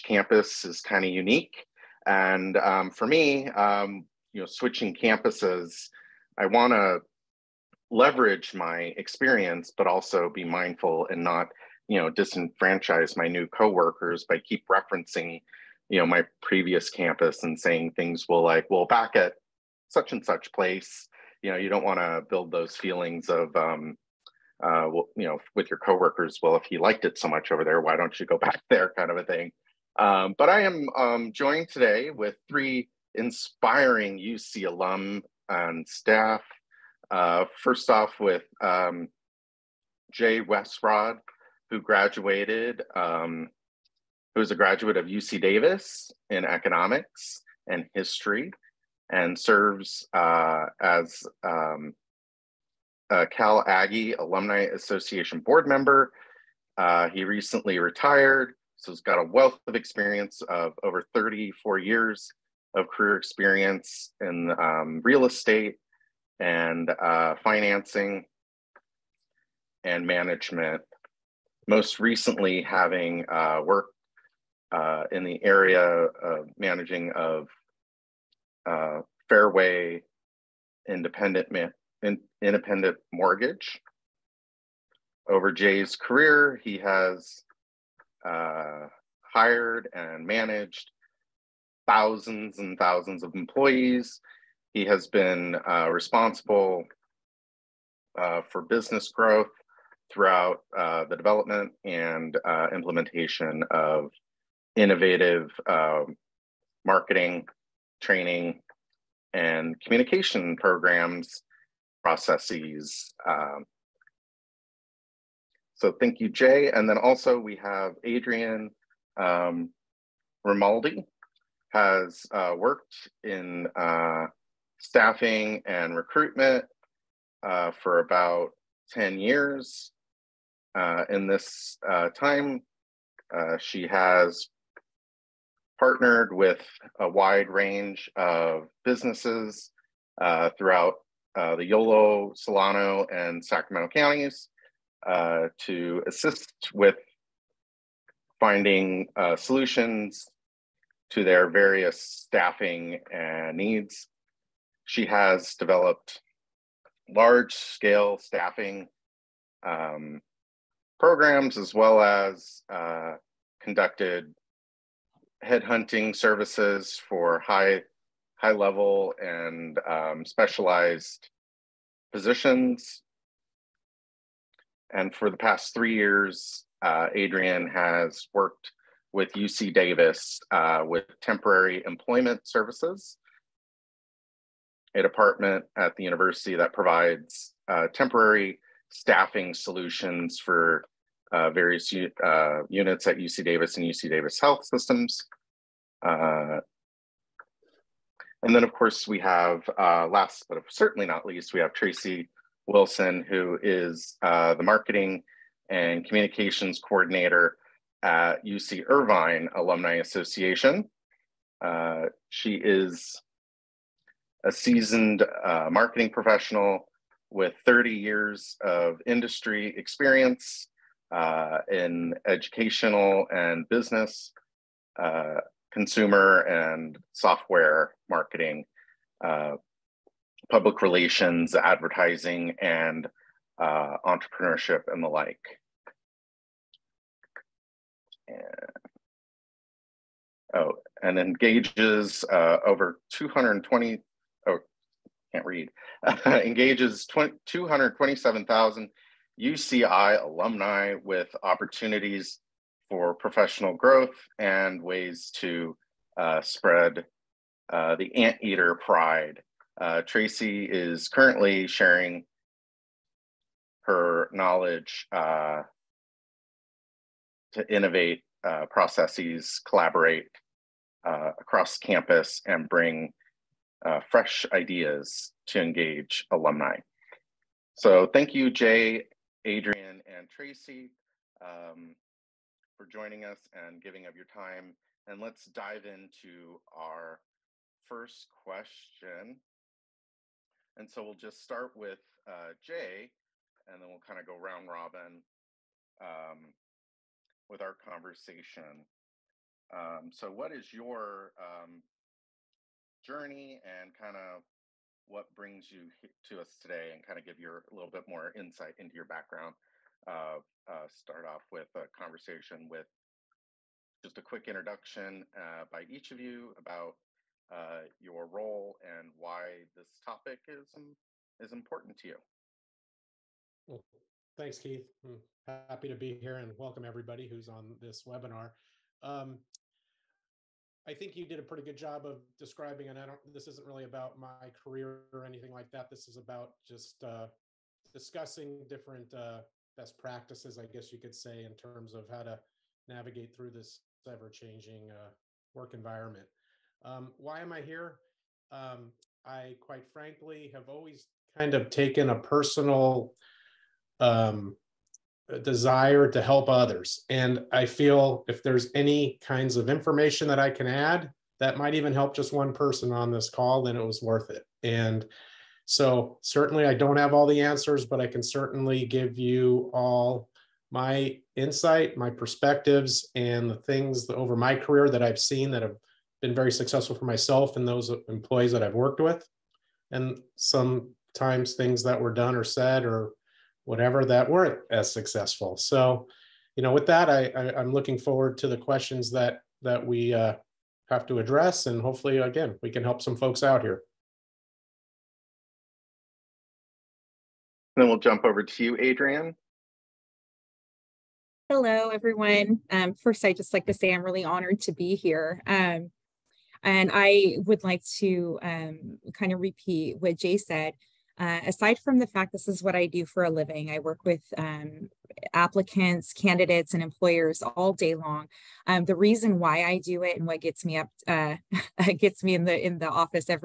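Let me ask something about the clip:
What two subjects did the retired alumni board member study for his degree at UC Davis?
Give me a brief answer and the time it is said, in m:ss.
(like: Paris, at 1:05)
economics and history, at 0:46.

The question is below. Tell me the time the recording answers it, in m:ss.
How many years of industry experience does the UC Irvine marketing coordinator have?
3:37.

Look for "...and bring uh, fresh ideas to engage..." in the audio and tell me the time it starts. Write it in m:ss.
4:32.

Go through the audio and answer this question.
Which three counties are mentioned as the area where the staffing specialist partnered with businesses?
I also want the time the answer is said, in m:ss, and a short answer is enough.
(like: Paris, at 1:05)
Yolo, Solano, and Sacramento, at 2:21.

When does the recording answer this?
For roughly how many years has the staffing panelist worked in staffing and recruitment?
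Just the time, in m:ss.
2:08.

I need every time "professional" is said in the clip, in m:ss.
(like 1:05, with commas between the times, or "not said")
3:36, 4:13.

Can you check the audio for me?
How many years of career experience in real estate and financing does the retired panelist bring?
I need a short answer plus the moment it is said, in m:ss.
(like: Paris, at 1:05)
34, at 1:01.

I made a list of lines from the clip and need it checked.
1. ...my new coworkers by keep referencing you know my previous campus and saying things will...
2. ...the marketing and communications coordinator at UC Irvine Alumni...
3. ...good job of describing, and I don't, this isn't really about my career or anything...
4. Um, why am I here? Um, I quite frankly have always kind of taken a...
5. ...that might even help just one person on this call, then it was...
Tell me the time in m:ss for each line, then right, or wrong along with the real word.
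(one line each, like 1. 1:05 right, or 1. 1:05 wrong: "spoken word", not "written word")
1. 0:13 right
2. 3:24 right
3. 5:31 right
4. 5:46 right
5. 6:01 right.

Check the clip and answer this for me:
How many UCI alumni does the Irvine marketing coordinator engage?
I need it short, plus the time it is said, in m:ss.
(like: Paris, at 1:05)
227,000, at 4:07.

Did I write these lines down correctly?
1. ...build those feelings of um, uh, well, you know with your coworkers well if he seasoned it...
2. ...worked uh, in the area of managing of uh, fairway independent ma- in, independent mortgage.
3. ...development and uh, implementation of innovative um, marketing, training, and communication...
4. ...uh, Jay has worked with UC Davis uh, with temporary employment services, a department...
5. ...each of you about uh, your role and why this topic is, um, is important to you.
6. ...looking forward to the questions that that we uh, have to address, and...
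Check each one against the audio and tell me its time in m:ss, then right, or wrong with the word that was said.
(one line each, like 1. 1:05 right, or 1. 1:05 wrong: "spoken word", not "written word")
1. 0:22 wrong: "liked", not "seasoned"
2. 1:13 right
3. 1:41 right
4. 2:56 wrong: "Adrienne", not "Jay"
5. 5:15 right
6. 6:27 right.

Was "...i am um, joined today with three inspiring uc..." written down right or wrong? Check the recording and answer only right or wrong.
right.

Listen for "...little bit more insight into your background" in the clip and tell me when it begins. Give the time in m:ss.
5:07.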